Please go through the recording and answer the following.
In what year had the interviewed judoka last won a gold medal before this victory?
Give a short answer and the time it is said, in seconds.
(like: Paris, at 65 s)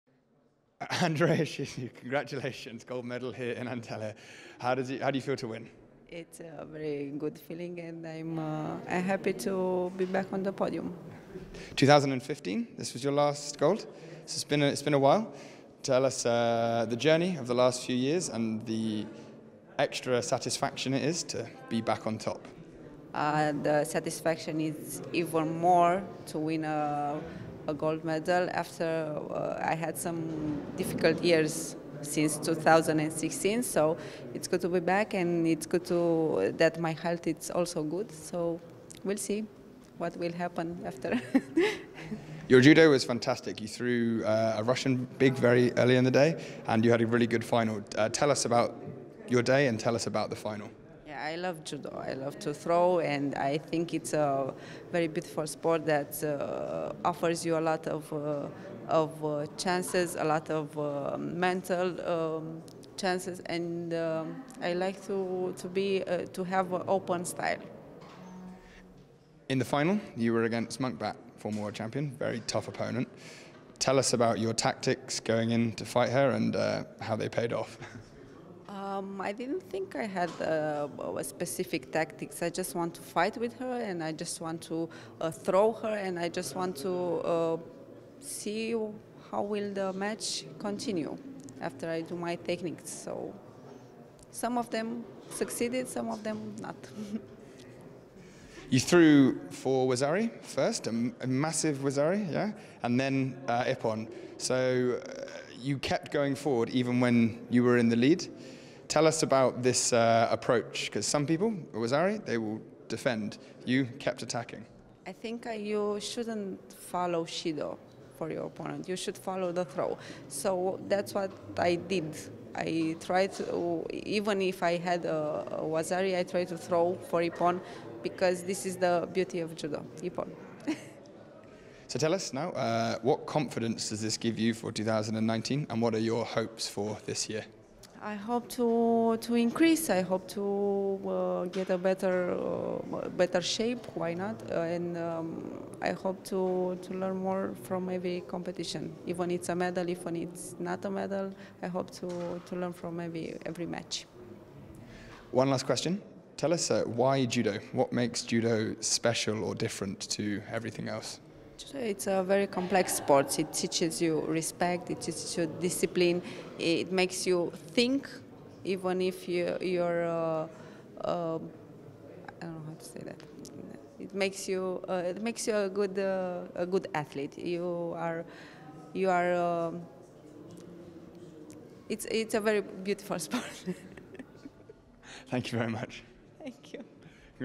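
2015, at 11 s.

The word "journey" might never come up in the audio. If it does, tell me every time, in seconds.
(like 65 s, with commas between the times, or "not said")
16 s.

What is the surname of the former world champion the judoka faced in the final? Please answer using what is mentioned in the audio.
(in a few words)
Munkhbat.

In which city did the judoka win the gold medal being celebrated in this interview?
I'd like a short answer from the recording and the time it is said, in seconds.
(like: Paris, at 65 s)
Antalya, at 3 s.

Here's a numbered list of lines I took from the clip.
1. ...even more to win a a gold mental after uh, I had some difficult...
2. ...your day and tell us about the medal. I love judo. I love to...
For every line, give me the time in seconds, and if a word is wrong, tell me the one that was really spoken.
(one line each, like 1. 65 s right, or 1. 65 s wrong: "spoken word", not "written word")
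1. 25 s wrong: "medal", not "mental"
2. 49 s wrong: "final", not "medal".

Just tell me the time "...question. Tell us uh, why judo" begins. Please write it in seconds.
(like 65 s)
155 s.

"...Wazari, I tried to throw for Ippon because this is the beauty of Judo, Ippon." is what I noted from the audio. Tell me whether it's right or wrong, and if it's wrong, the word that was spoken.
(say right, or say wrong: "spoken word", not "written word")
right.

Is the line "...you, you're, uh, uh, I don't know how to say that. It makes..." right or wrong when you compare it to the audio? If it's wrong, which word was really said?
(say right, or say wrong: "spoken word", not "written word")
right.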